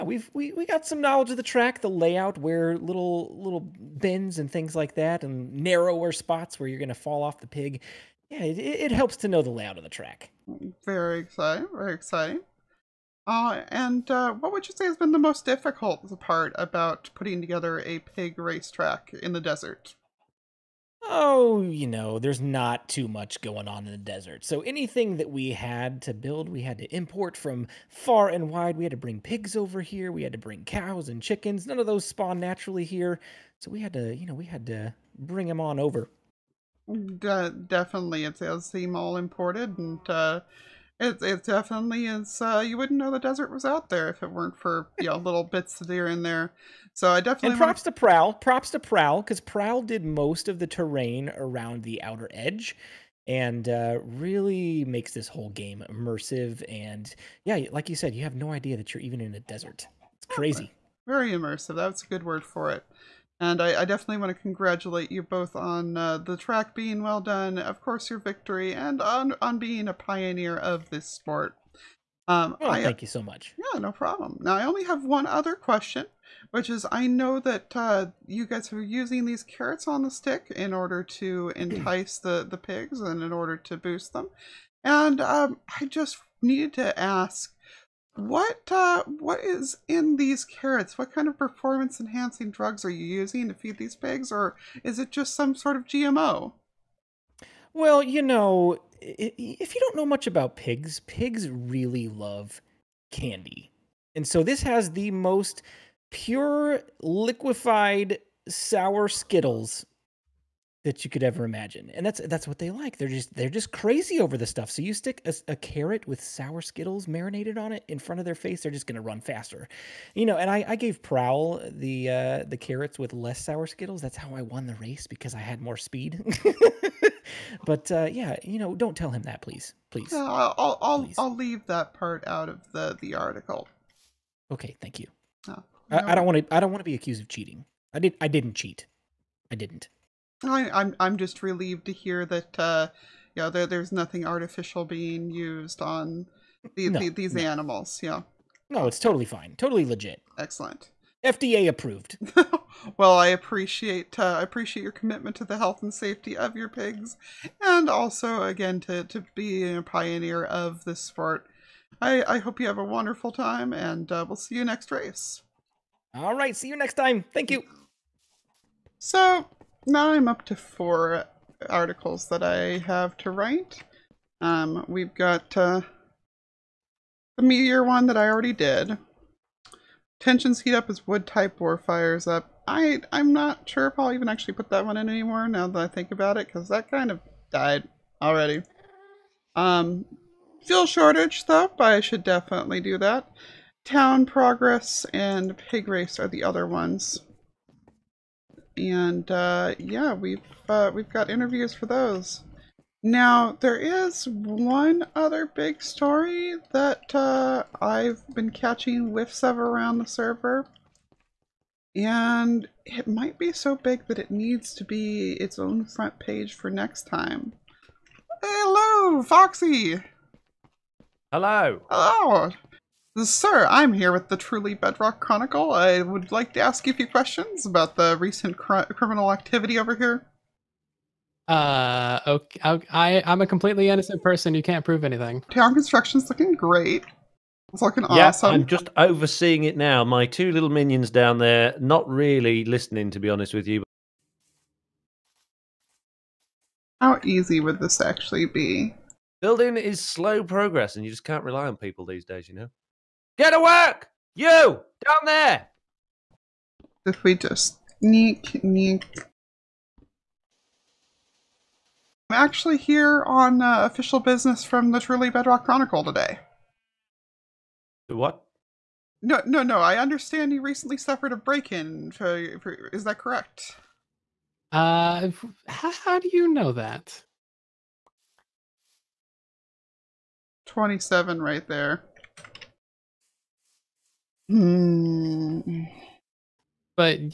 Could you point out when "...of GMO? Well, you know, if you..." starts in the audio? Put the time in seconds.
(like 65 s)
95 s.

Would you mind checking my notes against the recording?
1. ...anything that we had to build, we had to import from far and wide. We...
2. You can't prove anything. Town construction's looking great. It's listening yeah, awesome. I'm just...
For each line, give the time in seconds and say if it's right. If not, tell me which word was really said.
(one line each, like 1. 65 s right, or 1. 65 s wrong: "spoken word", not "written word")
1. 24 s right
2. 234 s wrong: "looking", not "listening".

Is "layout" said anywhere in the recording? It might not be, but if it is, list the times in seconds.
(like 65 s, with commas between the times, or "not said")
1 s, 9 s.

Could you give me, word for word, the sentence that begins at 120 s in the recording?
You know, and I, I gave Prowl the uh, the carrots with less sour Skittles.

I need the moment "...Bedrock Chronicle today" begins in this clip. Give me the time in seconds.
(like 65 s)
265 s.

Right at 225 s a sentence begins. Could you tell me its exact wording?
I would like to ask you a few questions about the recent cr criminal activity over here.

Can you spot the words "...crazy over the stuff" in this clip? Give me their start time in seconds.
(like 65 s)
113 s.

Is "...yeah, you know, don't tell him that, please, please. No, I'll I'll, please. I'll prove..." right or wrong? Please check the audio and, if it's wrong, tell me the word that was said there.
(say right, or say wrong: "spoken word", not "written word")
wrong: "leave", not "prove".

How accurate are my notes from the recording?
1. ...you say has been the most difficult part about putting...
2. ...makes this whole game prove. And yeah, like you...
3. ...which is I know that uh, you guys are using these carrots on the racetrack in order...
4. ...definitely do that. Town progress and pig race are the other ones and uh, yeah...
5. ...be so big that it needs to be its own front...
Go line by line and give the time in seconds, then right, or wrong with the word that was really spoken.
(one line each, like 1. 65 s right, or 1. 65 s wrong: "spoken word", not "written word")
1. 14 s right
2. 54 s wrong: "immersive", not "prove"
3. 76 s wrong: "stick", not "racetrack"
4. 192 s right
5. 213 s right.